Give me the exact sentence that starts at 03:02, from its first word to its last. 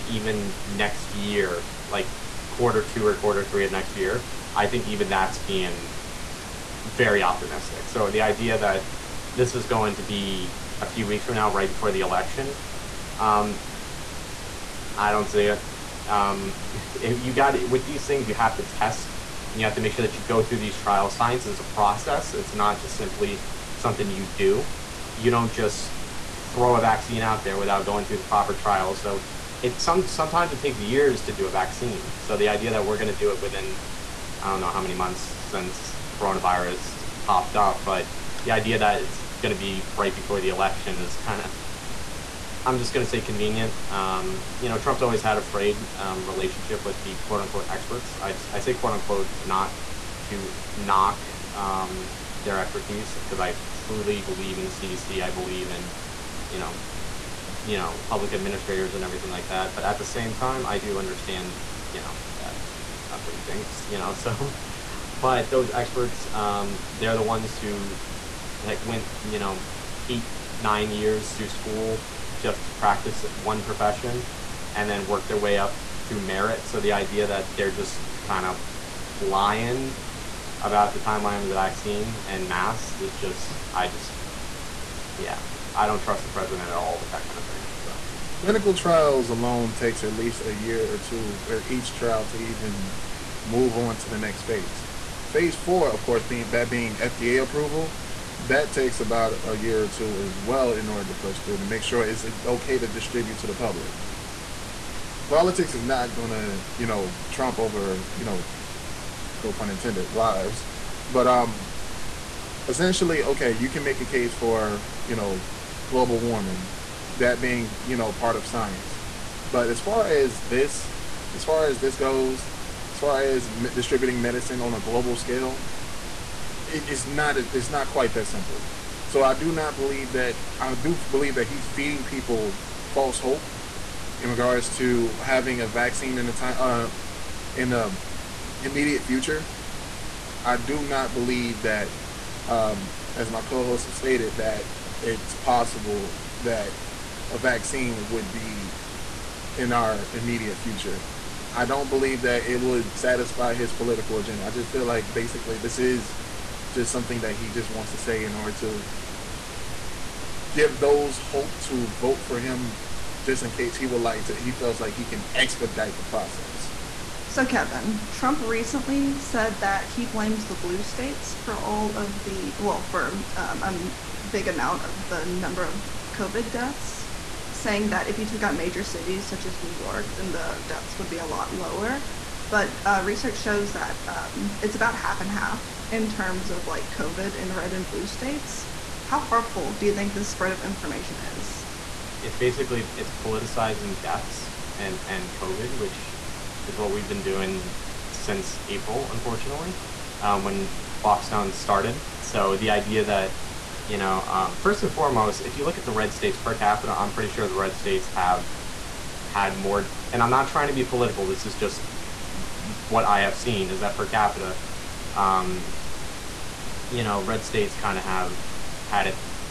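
But uh, research shows that um, it's about half and half in terms of like COVID in red and blue states.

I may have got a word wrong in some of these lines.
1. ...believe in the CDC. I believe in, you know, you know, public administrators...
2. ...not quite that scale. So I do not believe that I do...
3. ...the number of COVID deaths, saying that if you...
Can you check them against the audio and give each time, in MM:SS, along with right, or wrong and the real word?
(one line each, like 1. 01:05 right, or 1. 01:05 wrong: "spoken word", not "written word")
1. 00:54 right
2. 02:07 wrong: "simple", not "scale"
3. 02:55 right.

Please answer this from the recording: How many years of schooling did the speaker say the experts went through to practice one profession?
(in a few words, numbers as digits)
8 or 9.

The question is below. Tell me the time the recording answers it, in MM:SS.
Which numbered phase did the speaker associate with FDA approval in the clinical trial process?
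01:35.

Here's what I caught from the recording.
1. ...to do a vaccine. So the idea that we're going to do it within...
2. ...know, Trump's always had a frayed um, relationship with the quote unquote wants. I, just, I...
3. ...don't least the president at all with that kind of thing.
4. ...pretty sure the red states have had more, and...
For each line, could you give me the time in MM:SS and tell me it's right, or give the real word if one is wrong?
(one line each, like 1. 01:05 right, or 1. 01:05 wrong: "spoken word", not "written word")
1. 00:31 right
2. 00:44 wrong: "experts", not "wants"
3. 01:25 wrong: "trust", not "least"
4. 03:27 right.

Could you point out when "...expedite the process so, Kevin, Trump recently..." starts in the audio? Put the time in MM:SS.
02:45.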